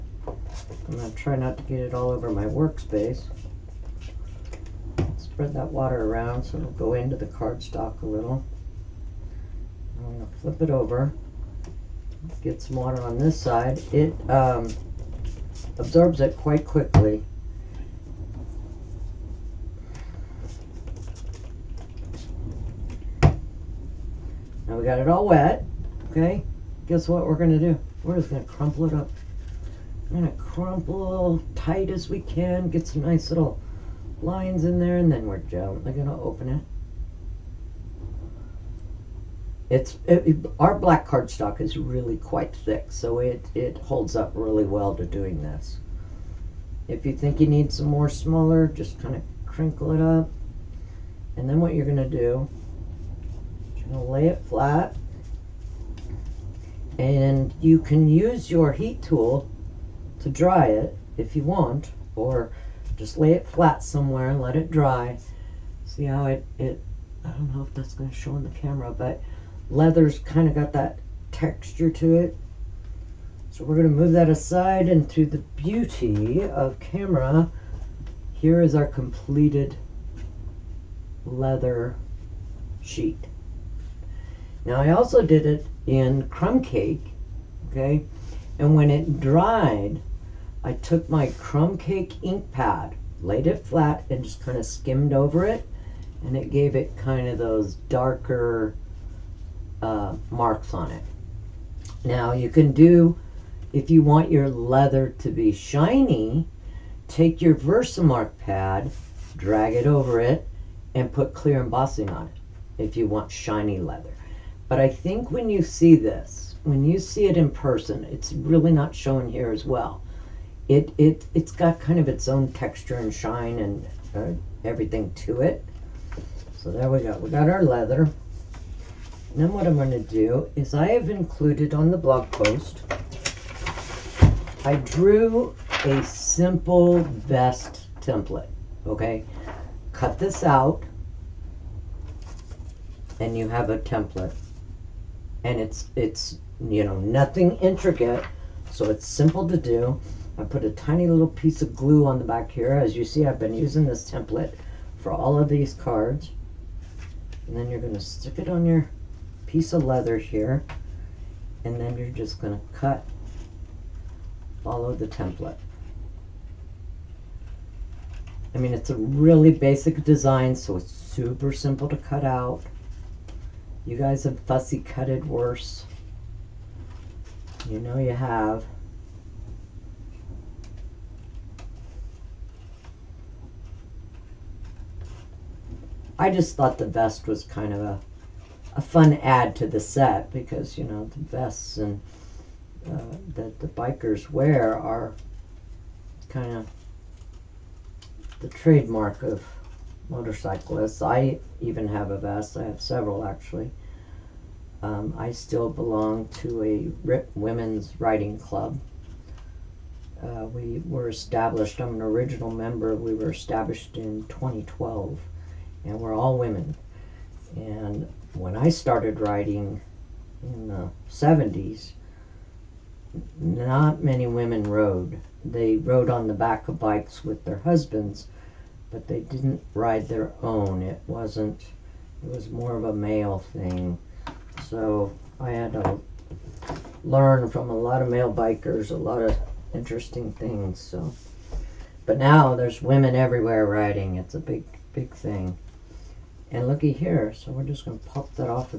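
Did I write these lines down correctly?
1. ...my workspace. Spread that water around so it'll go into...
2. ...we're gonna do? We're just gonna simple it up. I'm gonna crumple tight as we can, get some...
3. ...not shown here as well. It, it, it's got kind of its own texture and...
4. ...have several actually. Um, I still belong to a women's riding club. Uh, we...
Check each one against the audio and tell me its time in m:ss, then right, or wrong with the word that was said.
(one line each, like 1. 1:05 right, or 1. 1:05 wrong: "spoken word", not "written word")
1. 0:02 right
2. 0:27 wrong: "crumple", not "simple"
3. 1:58 right
4. 3:22 right.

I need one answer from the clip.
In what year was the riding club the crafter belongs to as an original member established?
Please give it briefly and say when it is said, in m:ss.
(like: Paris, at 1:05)
2012, at 3:34.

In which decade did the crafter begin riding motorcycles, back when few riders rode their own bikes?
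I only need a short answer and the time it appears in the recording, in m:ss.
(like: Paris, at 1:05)
The 70s, at 3:40.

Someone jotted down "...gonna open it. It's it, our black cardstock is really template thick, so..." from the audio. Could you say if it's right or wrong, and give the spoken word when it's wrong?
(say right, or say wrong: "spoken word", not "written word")
wrong: "quite", not "template".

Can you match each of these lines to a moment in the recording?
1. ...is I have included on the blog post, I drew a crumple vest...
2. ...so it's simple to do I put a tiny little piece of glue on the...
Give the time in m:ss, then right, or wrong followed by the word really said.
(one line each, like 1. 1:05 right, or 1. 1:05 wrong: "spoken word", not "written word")
1. 2:10 wrong: "simple", not "crumple"
2. 2:28 right.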